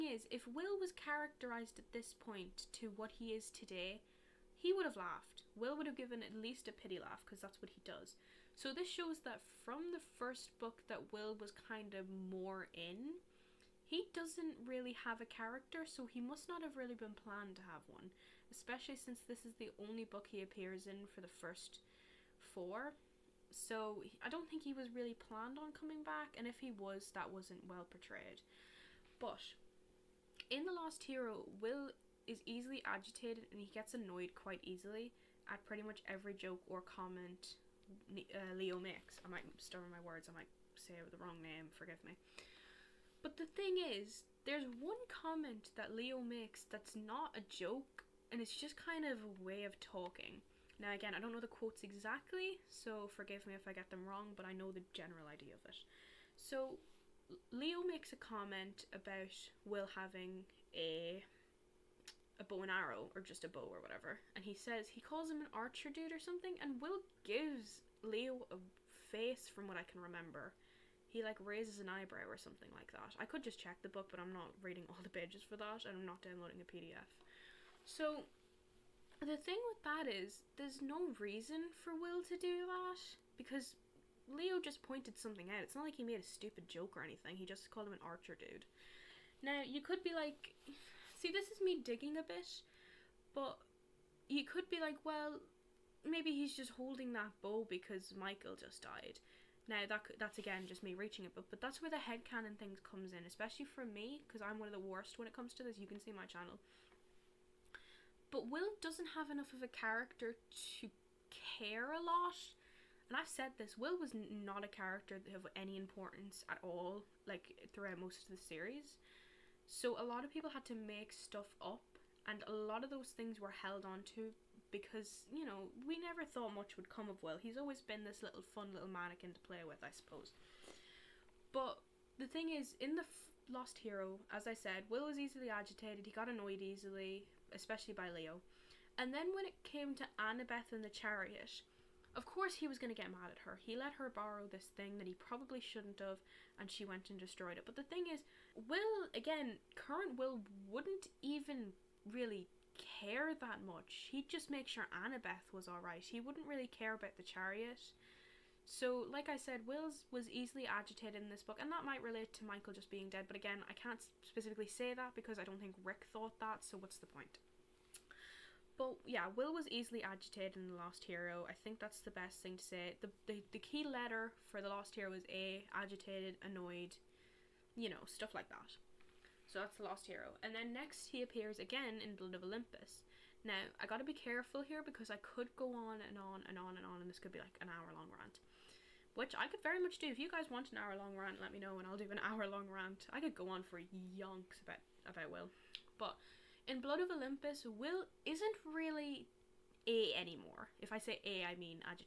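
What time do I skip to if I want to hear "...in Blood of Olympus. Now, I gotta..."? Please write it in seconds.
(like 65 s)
181 s.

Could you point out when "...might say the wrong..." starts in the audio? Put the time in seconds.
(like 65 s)
40 s.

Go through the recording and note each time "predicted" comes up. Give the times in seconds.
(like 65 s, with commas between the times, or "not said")
not said.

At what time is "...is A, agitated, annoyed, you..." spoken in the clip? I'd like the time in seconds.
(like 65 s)
175 s.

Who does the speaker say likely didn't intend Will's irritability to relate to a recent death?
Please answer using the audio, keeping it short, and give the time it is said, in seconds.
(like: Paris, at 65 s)
Rick, at 165 s.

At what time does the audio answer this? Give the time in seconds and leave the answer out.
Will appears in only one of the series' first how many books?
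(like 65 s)
22 s.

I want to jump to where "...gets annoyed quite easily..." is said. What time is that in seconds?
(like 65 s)
33 s.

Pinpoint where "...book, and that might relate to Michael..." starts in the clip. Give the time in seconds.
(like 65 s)
161 s.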